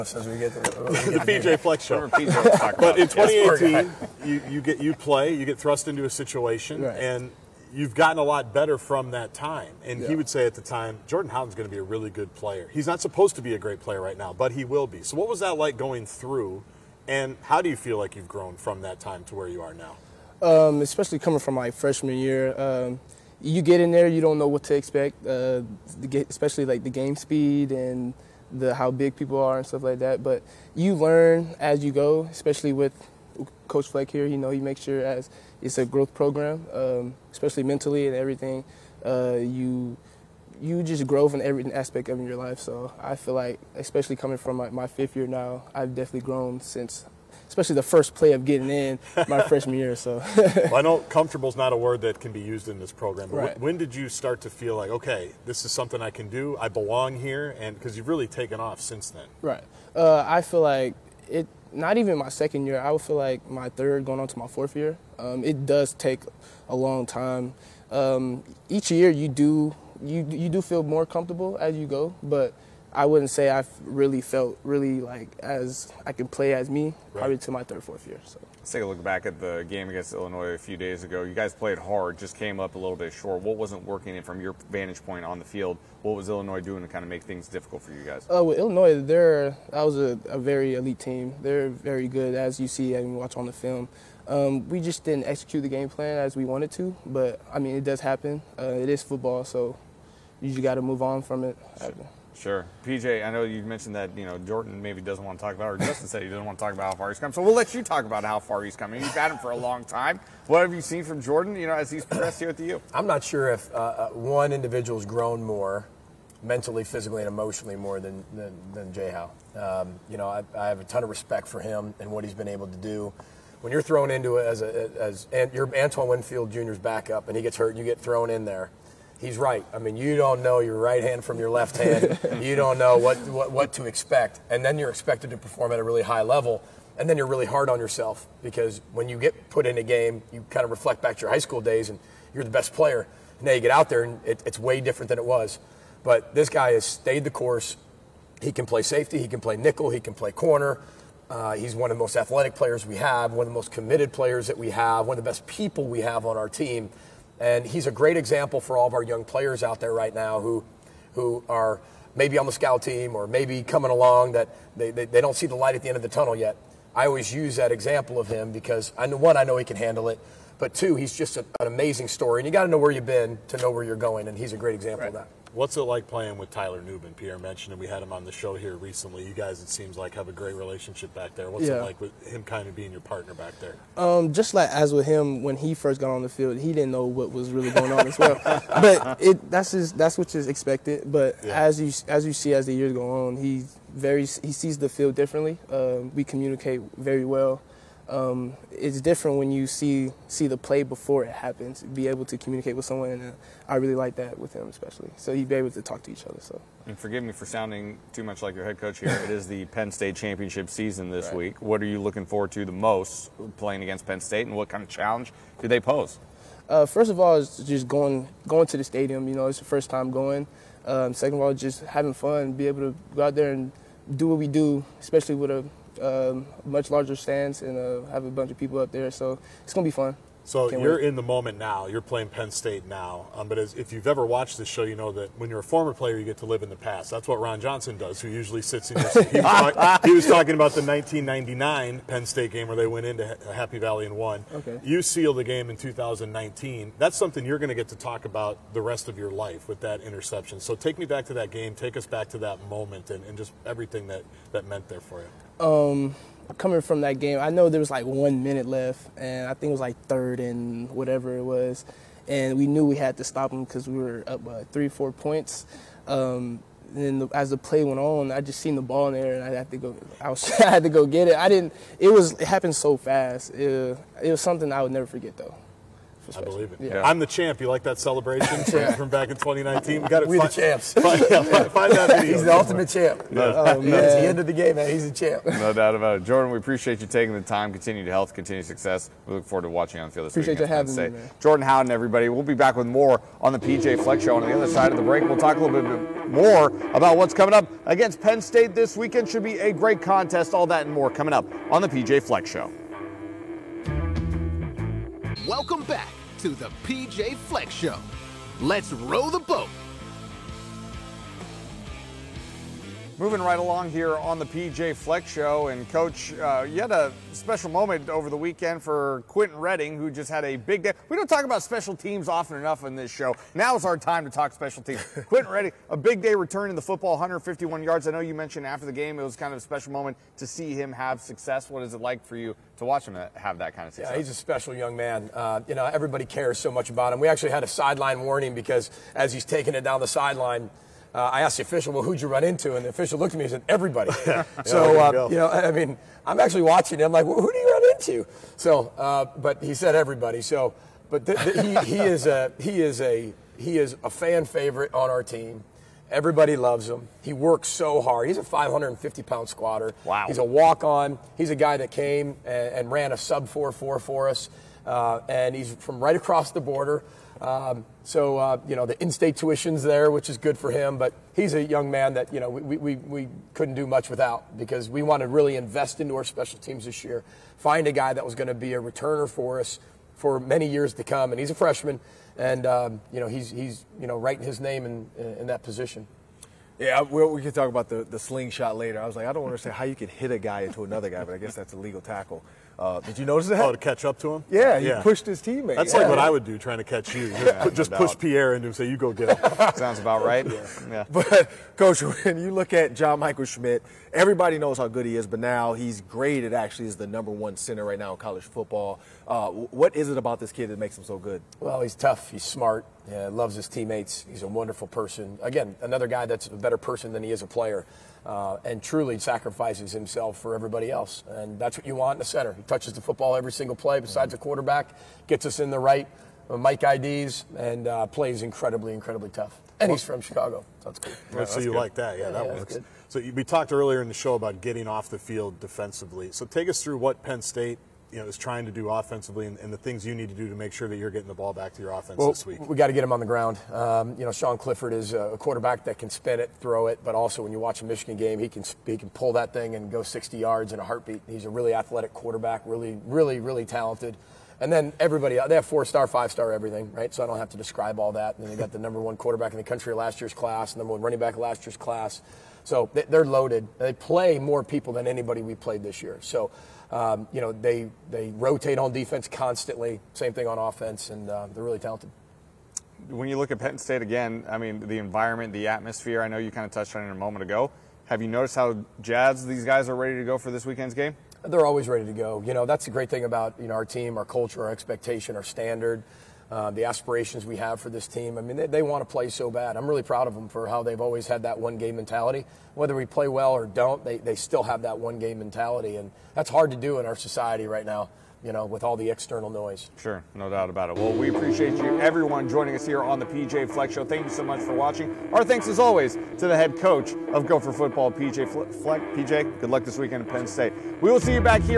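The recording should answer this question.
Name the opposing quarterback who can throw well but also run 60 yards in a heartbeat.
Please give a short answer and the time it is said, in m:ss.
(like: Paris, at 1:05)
Sean Clifford, at 7:24.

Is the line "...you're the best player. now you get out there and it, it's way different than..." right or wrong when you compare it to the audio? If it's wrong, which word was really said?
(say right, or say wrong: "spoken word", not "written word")
right.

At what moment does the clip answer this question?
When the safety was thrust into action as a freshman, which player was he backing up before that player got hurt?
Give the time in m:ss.
2:05.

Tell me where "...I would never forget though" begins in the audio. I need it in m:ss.
4:34.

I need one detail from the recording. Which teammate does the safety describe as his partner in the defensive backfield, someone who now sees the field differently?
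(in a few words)
Tyler Nubin.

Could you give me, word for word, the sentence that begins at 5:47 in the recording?
I'm like, well, who do you run into?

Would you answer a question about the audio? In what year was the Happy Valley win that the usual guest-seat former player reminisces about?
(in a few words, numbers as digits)
1999.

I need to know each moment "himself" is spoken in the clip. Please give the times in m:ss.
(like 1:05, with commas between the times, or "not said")
6:59.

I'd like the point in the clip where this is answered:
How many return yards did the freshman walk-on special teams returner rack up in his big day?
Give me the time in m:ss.
5:27.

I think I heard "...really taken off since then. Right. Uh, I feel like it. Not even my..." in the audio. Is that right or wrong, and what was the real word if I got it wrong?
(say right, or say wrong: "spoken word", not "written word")
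right.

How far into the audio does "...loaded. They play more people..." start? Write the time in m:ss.
7:43.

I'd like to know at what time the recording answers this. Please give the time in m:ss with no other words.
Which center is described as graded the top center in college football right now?
6:42.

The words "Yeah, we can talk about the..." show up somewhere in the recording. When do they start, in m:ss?
6:26.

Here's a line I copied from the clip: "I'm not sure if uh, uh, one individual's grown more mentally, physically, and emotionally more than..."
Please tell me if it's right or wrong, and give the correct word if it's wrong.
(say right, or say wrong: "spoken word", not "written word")
right.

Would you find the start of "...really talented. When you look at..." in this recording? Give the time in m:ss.
7:51.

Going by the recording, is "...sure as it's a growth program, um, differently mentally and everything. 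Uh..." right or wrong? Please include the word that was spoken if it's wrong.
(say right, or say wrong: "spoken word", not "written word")
wrong: "especially", not "differently".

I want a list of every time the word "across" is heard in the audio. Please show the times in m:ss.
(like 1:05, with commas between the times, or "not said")
6:06.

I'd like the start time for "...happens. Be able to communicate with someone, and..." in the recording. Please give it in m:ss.
3:21.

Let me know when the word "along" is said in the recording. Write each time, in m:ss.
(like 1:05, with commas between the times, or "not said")
2:43, 5:13.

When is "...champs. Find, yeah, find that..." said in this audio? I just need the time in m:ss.
4:40.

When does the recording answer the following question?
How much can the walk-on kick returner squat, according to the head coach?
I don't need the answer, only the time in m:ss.
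5:58.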